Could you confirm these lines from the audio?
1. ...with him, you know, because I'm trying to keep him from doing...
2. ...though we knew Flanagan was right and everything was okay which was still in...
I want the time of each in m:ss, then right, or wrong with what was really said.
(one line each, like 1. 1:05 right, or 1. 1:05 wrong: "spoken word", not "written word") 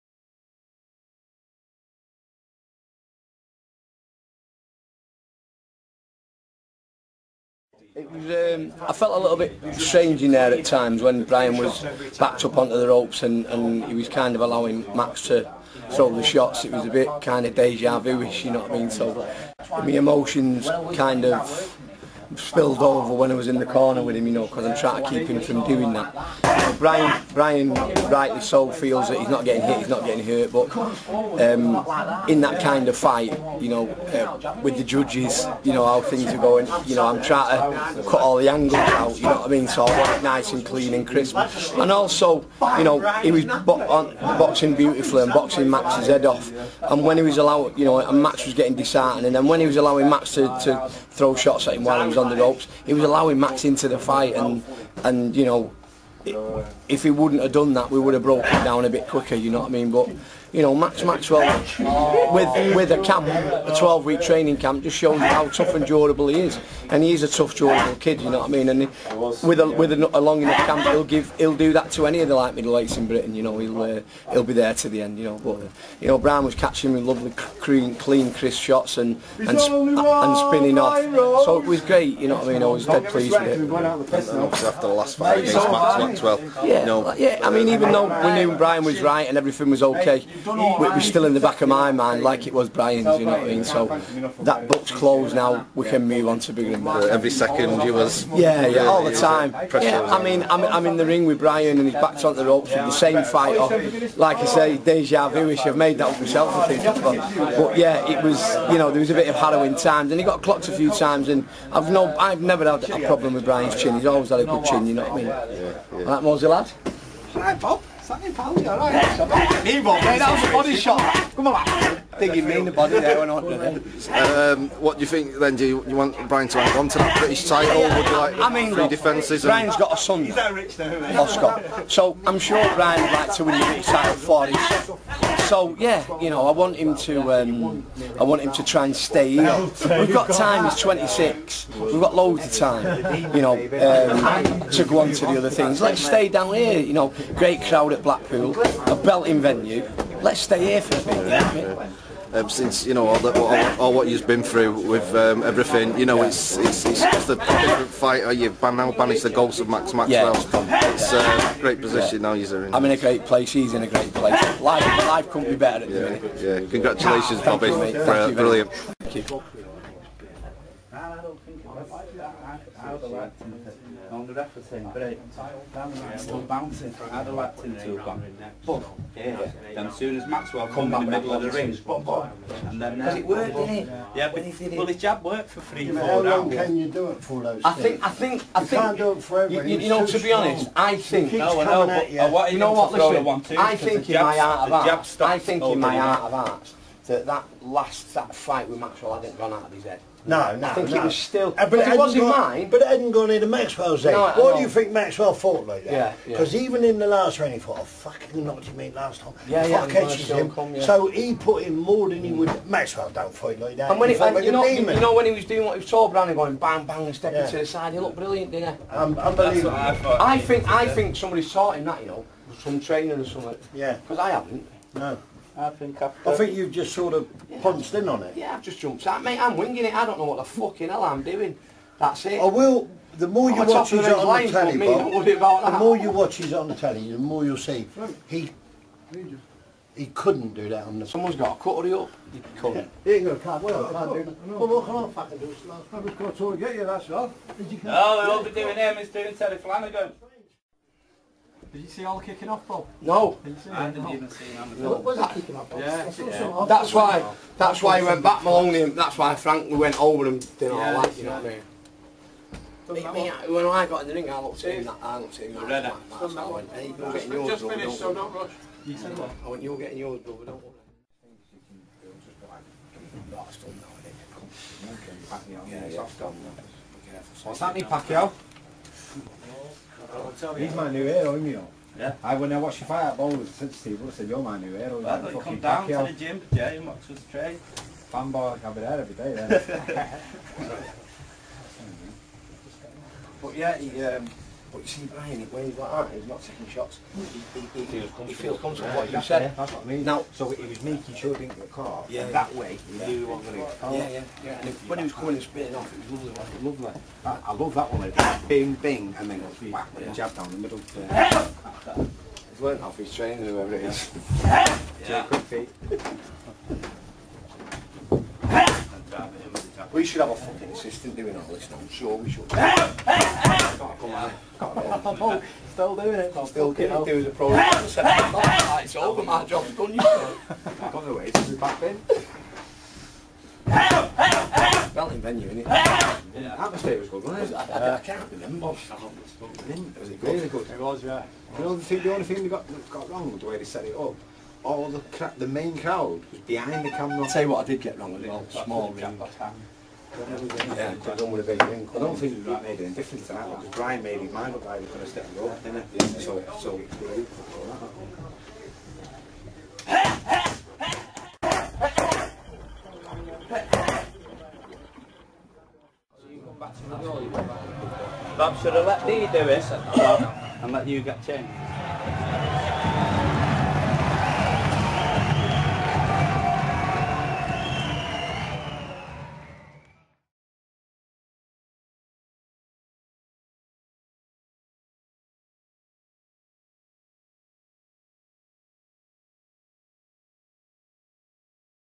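1. 0:24 right
2. 1:27 wrong: "Brian", not "Flanagan".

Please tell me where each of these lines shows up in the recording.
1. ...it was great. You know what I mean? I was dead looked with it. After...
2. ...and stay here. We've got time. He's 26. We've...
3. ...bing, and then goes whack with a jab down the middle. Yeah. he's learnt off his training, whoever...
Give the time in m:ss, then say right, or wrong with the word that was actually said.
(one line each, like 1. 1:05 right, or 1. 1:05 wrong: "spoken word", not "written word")
1. 1:21 wrong: "pleased", not "looked"
2. 2:18 right
3. 5:08 right.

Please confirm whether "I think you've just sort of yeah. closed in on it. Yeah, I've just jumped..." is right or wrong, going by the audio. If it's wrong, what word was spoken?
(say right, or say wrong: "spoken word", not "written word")
wrong: "punched", not "closed".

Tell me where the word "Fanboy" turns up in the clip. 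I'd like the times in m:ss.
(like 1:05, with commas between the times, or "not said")
4:48.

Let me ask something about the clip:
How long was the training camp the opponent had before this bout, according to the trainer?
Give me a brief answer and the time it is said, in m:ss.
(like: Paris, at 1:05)
12 weeks, at 1:03.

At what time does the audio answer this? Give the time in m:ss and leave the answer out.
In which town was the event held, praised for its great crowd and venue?
2:28.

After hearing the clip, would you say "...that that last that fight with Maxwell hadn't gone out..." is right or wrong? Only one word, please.
right.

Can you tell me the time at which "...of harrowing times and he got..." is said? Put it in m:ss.
1:49.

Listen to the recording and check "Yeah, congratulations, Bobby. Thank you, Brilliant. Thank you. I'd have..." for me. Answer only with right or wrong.
right.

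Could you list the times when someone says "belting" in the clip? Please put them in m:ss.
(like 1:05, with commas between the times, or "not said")
2:28, 5:34.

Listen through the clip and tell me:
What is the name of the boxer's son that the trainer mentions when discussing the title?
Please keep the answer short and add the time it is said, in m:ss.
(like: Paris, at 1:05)
Oscar, at 2:11.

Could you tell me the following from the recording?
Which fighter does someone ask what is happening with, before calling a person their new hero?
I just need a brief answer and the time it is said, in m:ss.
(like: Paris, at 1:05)
Pacquiao, at 4:37.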